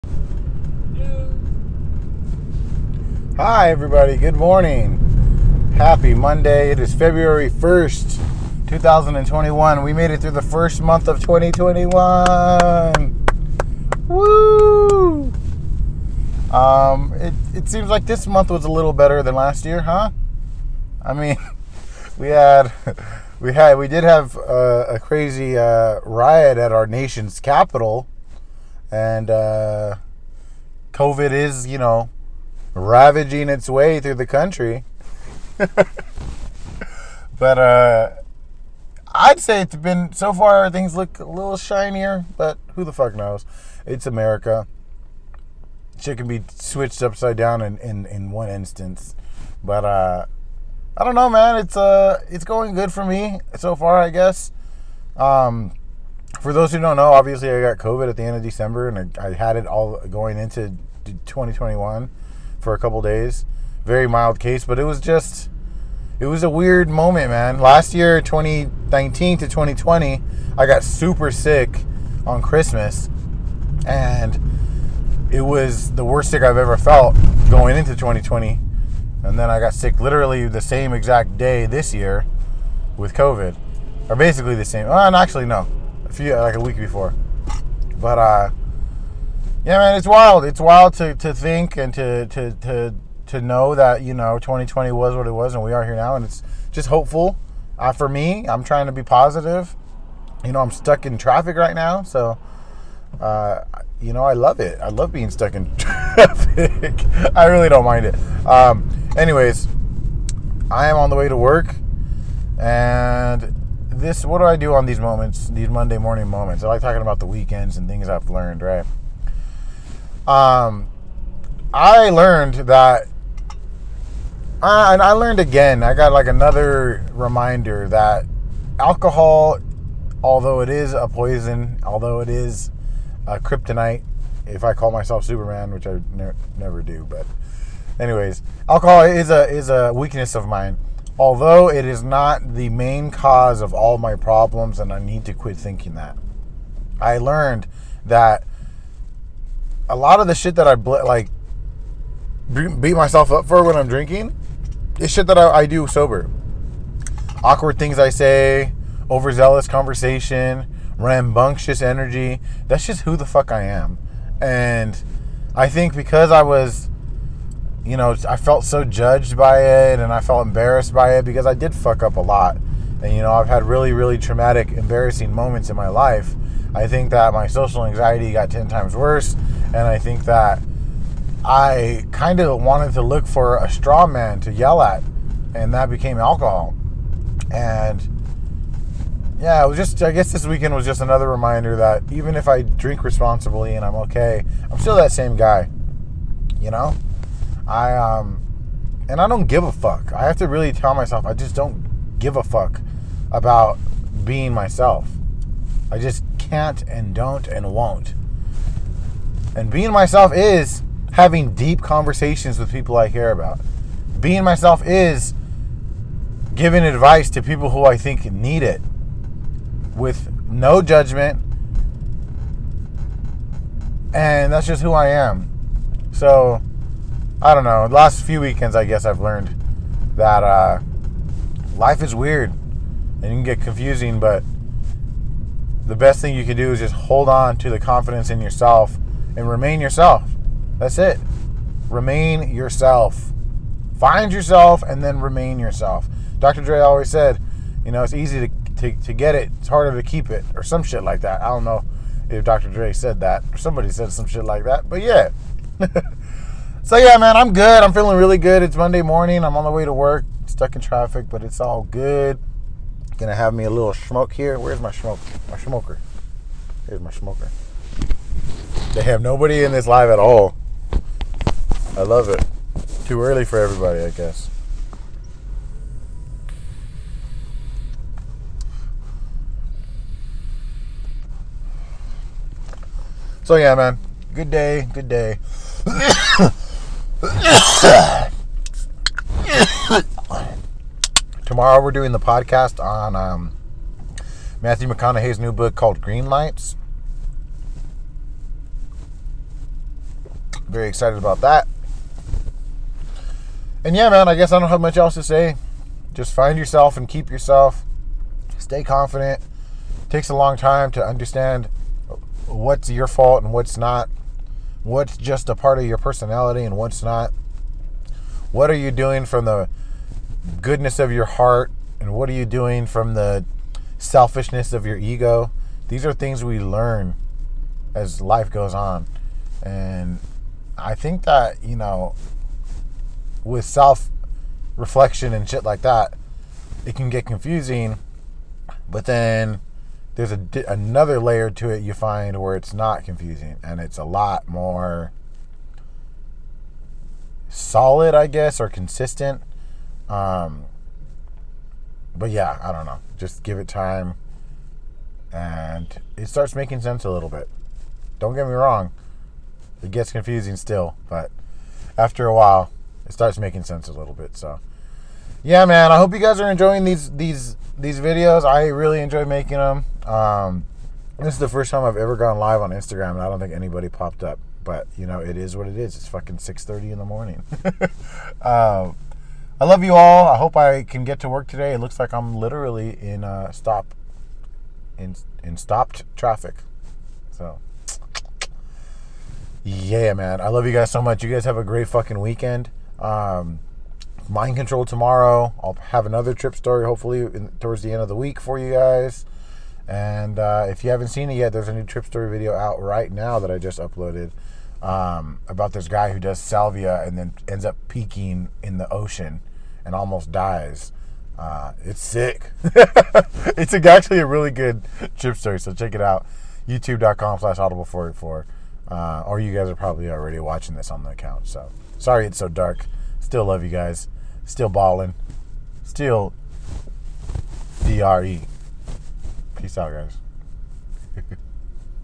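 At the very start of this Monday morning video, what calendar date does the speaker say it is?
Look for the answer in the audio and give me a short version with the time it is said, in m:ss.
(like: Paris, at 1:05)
February 1st, 2021, at 0:06.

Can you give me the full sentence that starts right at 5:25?
These are things we learn as life goes on.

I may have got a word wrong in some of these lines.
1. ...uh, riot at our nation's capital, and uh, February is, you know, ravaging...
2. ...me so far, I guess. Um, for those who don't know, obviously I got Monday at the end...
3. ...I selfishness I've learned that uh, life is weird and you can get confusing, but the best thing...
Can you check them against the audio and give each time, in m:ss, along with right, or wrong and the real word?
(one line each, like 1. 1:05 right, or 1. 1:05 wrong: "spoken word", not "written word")
1. 0:25 wrong: "COVID", not "February"
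2. 0:53 wrong: "COVID", not "Monday"
3. 3:48 wrong: "guess", not "selfishness".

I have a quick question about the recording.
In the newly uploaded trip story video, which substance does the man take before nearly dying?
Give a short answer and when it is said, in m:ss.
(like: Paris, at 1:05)
salvia, at 6:46.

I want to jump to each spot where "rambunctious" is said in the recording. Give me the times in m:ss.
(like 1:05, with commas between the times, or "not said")
2:40.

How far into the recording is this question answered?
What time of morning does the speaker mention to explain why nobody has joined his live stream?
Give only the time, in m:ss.
6:16.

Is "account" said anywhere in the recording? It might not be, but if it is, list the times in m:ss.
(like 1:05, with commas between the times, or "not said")
7:01.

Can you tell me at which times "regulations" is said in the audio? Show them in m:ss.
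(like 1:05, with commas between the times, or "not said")
not said.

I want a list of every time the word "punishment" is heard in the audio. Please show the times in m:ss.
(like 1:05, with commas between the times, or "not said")
not said.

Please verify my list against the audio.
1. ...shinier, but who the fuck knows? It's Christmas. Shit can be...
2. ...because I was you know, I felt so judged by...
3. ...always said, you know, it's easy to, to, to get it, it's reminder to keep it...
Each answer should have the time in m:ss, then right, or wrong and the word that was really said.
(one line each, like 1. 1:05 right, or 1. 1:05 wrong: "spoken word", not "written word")
1. 0:41 wrong: "America", not "Christmas"
2. 2:45 right
3. 4:06 wrong: "harder", not "reminder".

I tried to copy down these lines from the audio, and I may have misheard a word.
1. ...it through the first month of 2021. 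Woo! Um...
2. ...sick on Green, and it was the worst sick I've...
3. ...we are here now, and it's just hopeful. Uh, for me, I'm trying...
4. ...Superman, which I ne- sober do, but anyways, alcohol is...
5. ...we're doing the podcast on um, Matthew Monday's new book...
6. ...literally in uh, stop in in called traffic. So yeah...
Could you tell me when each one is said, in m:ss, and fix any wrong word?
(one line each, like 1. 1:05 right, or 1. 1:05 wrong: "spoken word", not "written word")
1. 0:10 right
2. 1:11 wrong: "Christmas", not "Green"
3. 1:35 right
4. 2:15 wrong: "never", not "sober"
5. 4:51 wrong: "McConaughey", not "Monday"
6. 6:22 wrong: "stopped", not "called".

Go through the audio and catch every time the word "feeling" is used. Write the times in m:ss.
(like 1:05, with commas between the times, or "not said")
4:17.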